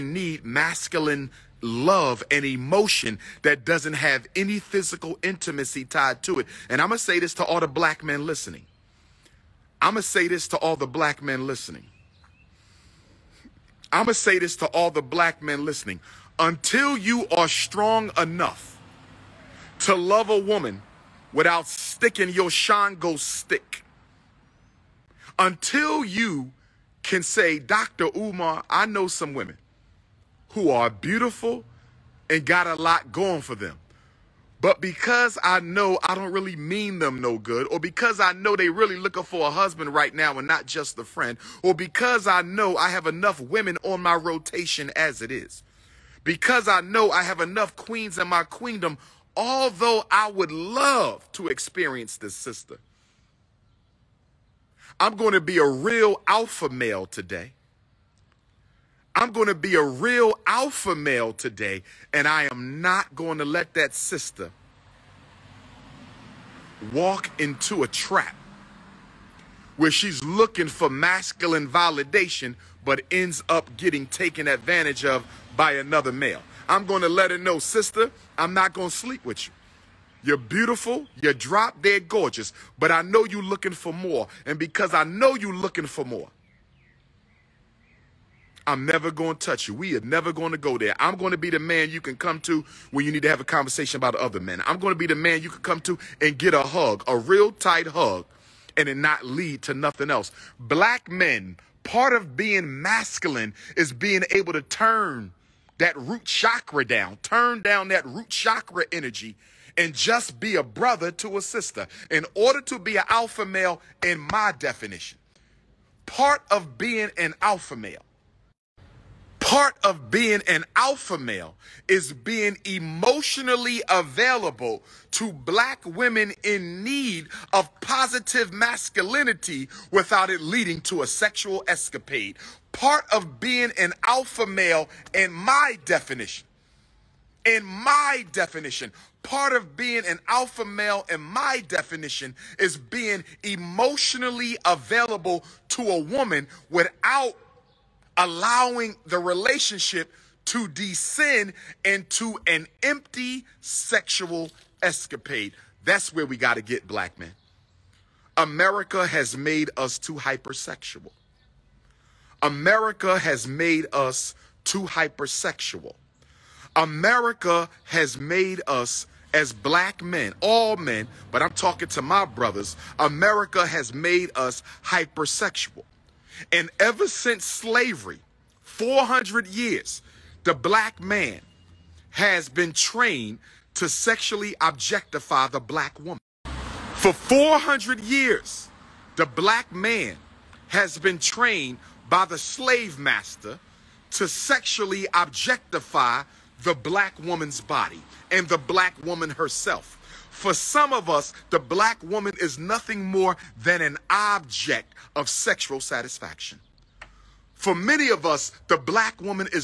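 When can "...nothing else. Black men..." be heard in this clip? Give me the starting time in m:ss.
1:39.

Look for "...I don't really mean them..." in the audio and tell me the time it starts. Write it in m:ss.
0:36.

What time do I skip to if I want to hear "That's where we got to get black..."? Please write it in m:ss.
2:35.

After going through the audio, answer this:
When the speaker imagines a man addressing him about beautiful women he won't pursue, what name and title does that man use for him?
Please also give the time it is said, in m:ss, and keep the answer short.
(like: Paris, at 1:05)
Dr. Umar, at 0:27.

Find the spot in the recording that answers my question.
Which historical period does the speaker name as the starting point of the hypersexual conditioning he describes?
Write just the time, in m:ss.
2:57.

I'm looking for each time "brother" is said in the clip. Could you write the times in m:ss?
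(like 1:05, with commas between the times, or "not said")
1:50, 2:52.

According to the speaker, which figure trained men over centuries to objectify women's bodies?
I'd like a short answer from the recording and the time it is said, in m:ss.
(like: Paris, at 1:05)
the slave master, at 3:12.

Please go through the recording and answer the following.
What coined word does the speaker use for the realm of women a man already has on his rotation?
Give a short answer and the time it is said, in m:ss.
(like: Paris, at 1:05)
queendom, at 0:48.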